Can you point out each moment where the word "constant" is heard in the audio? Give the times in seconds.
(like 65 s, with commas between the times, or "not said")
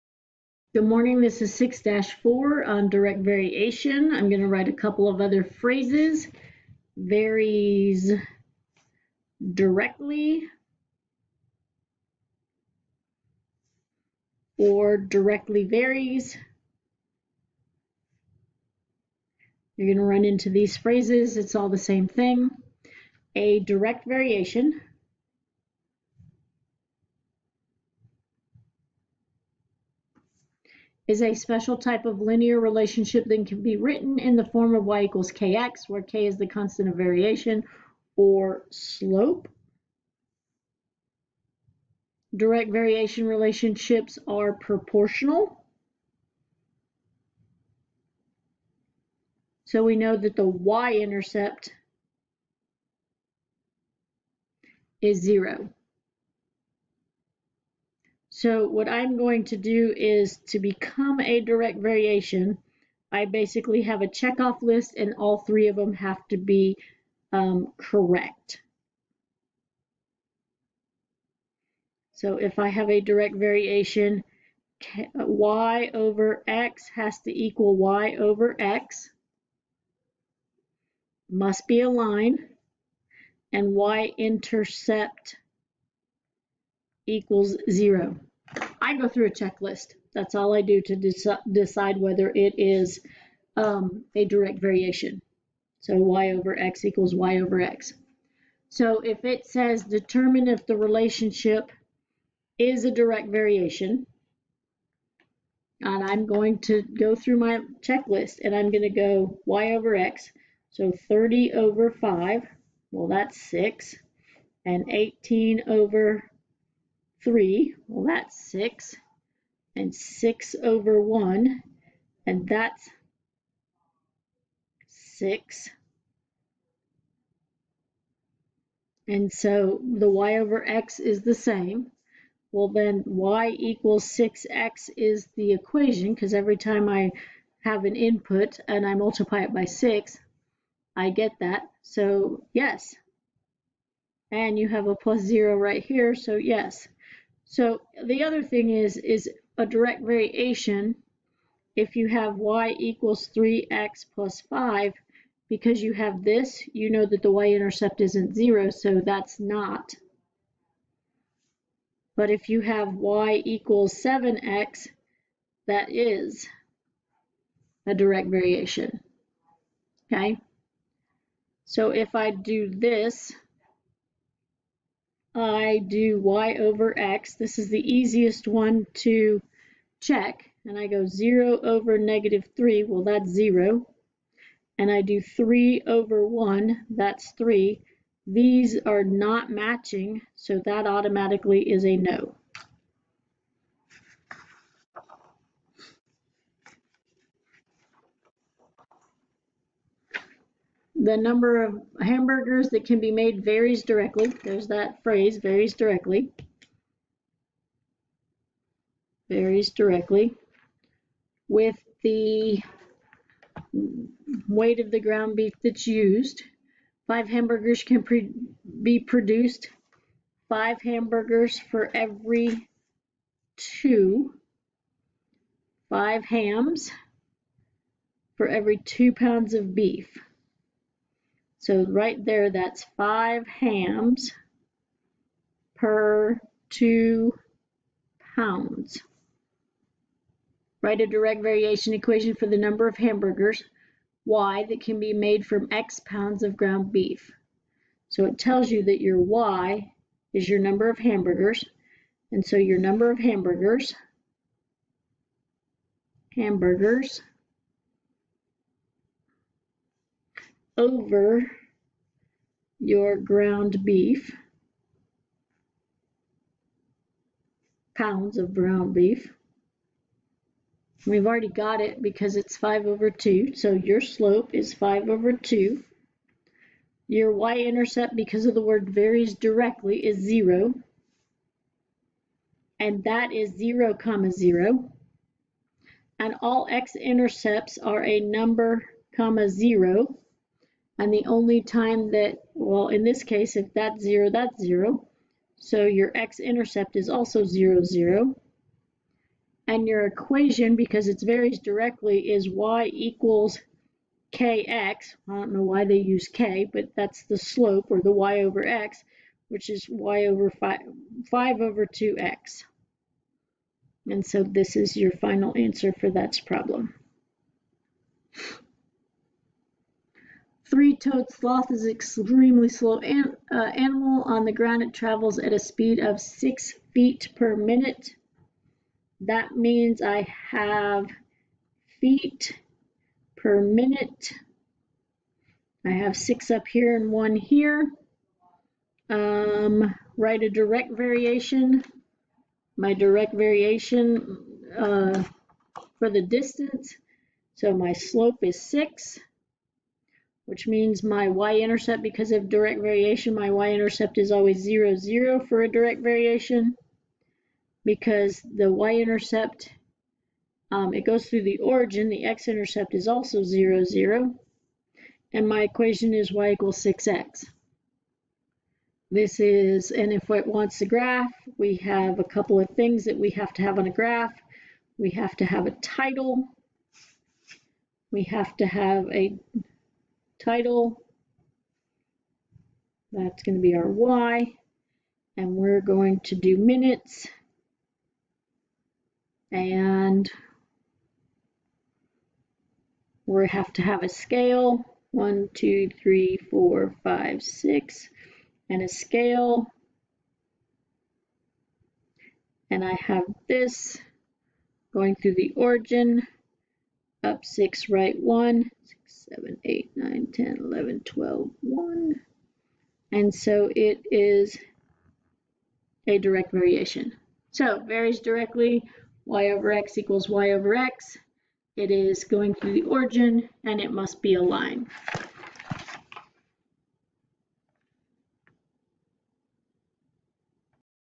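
36 s.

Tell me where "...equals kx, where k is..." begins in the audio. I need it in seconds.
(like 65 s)
35 s.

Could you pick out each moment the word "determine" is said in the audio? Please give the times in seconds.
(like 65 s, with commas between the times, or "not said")
99 s.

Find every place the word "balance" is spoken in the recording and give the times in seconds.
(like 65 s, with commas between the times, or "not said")
not said.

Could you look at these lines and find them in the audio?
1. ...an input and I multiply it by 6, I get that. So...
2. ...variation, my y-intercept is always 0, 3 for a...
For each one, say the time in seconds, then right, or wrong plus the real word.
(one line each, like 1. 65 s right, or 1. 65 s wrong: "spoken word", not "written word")
1. 137 s right
2. 352 s wrong: "0", not "3".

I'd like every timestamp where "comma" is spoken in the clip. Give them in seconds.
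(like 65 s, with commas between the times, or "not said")
283 s, 289 s.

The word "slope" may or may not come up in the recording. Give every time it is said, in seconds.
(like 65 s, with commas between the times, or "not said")
38 s, 274 s, 307 s, 347 s.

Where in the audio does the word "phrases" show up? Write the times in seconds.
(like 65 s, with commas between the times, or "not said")
5 s, 20 s, 205 s.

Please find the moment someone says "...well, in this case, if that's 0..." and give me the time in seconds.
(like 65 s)
292 s.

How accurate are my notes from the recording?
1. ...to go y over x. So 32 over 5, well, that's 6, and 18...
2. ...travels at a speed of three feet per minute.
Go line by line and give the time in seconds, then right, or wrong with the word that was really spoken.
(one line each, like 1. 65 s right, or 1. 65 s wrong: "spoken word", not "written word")
1. 108 s wrong: "30", not "32"
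2. 324 s wrong: "six", not "three".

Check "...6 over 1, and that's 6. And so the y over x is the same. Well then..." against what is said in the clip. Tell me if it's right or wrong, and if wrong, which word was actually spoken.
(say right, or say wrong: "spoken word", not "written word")
right.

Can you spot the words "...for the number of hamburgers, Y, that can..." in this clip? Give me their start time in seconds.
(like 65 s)
242 s.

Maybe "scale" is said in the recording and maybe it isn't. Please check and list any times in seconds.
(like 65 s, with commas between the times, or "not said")
394 s, 398 s.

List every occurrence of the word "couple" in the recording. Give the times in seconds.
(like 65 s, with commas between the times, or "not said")
4 s, 372 s.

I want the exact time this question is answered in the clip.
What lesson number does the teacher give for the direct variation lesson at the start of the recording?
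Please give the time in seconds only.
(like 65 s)
1 s.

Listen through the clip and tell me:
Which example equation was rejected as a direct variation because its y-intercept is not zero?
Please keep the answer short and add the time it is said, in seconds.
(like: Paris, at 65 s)
y = 3x + 5, at 152 s.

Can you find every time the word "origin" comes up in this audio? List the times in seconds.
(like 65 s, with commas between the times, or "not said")
361 s, 405 s, 422 s.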